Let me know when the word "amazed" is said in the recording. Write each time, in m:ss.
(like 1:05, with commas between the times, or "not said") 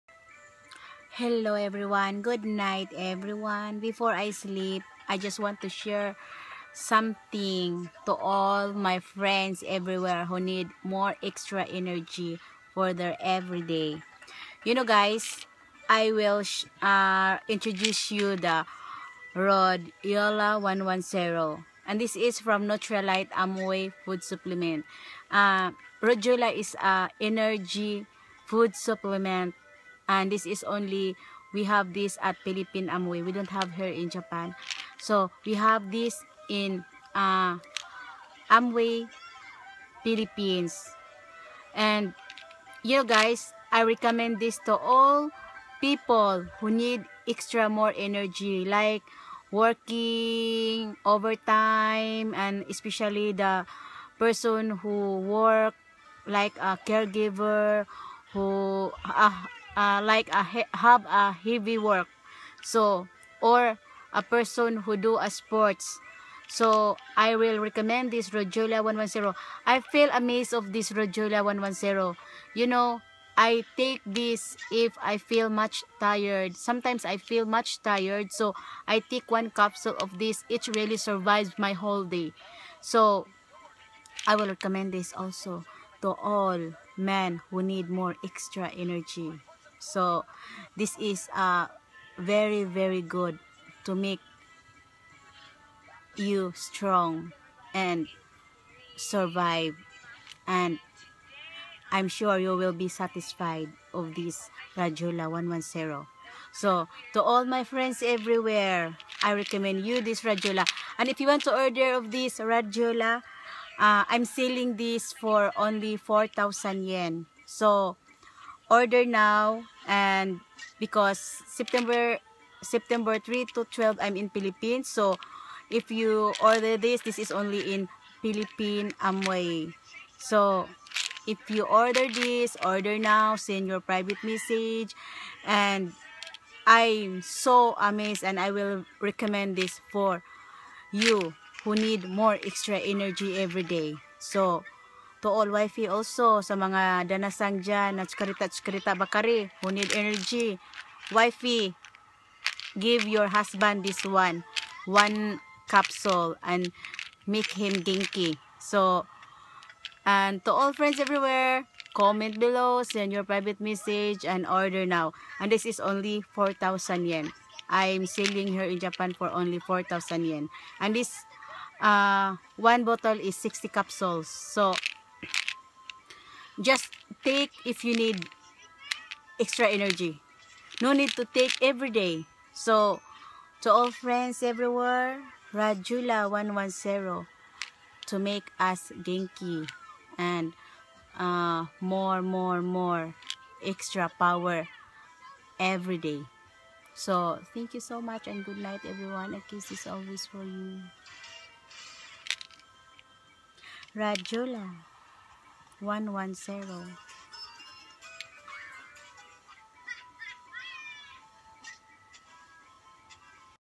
1:10, 2:17.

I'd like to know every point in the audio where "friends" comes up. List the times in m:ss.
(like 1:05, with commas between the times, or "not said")
0:08, 1:47, 2:40, 3:03.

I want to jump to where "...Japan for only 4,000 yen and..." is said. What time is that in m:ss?
2:48.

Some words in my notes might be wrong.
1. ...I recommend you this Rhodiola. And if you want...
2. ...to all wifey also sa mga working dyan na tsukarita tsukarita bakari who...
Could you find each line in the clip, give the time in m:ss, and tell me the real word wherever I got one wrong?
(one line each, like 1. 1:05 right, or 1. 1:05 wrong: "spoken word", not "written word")
1. 1:49 right
2. 2:25 wrong: "danasang", not "working".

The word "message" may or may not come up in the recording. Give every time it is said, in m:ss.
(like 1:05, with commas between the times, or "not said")
2:14, 2:43.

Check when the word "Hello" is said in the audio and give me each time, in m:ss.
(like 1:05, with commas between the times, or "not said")
0:01.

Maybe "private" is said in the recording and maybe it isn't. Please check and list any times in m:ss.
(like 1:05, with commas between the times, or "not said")
2:13, 2:43.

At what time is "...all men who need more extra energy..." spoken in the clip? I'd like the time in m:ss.
1:26.